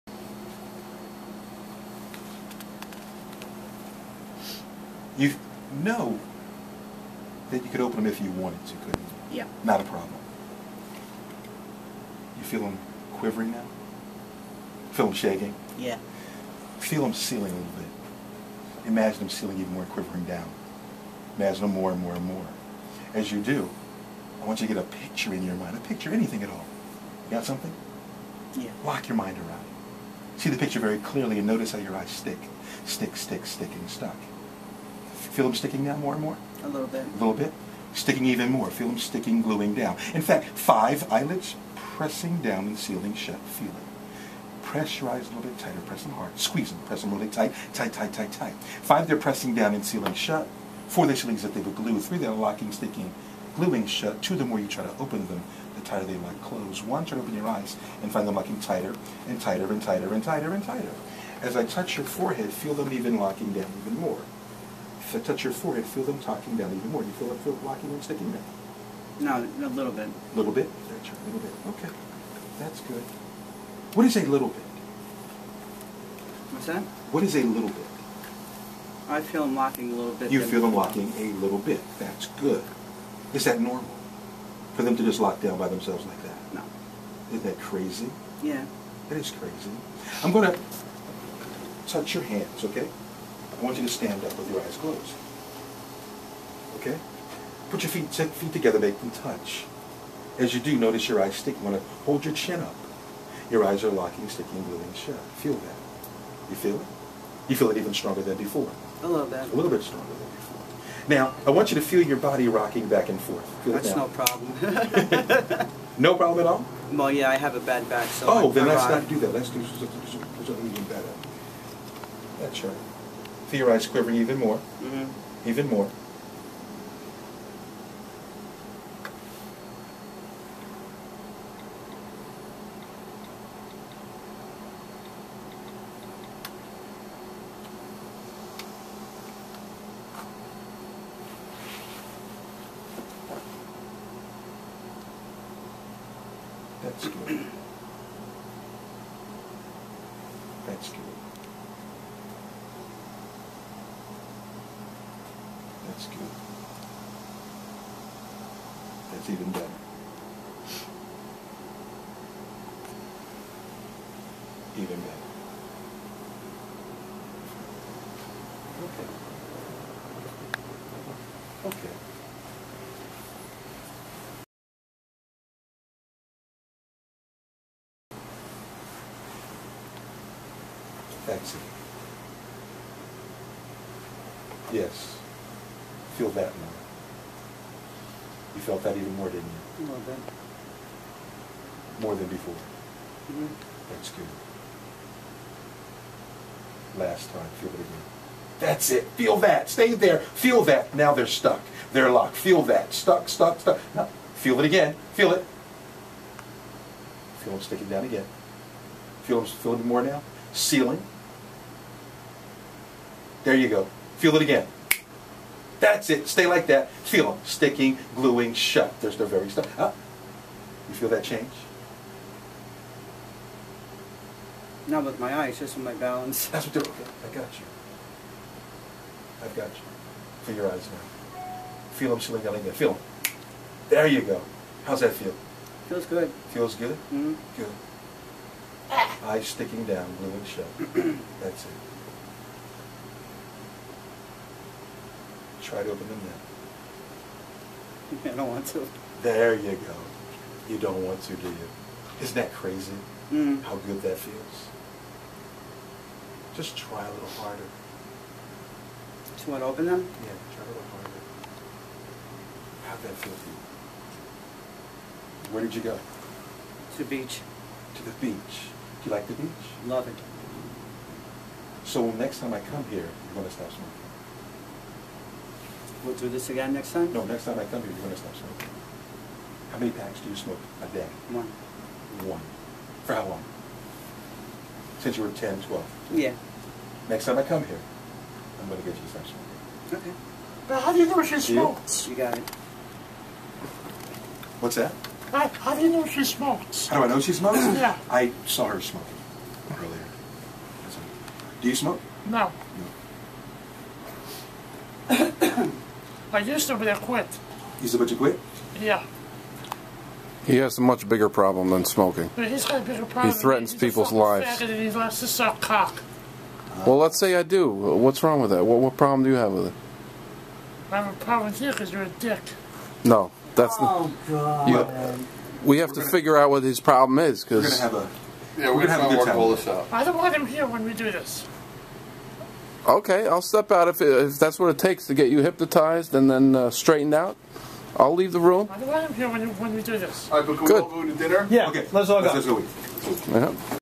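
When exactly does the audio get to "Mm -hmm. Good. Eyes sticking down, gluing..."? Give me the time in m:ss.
3:57.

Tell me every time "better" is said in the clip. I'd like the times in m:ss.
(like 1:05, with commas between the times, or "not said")
2:00, 2:39, 2:45.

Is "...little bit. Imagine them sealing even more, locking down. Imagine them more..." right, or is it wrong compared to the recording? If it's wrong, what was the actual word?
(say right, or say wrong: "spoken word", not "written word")
wrong: "quivering", not "locking".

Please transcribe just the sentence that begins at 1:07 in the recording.
Do you feel that feel blocking and sticking down?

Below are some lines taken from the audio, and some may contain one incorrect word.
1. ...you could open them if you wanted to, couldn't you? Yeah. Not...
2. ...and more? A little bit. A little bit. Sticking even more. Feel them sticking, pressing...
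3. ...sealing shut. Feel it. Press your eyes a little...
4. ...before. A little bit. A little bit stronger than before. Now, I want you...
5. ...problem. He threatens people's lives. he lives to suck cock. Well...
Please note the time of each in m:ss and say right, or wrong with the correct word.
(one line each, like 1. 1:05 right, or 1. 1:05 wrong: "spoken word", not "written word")
1. 0:07 right
2. 0:36 wrong: "gluing", not "pressing"
3. 0:42 right
4. 1:48 right
5. 5:13 wrong: "loves", not "lives".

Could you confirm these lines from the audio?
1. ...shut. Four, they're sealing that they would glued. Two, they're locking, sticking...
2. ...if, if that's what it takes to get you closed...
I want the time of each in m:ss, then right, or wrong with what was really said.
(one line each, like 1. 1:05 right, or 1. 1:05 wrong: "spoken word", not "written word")
1. 0:50 wrong: "Three", not "Two"
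2. 5:33 wrong: "hypnotized", not "closed".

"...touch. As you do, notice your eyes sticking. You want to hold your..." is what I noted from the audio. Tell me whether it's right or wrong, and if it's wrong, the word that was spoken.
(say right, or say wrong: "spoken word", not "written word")
right.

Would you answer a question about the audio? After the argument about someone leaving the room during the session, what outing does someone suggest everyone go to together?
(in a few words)
dinner.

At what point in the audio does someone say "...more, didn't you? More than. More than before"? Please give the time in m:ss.
3:09.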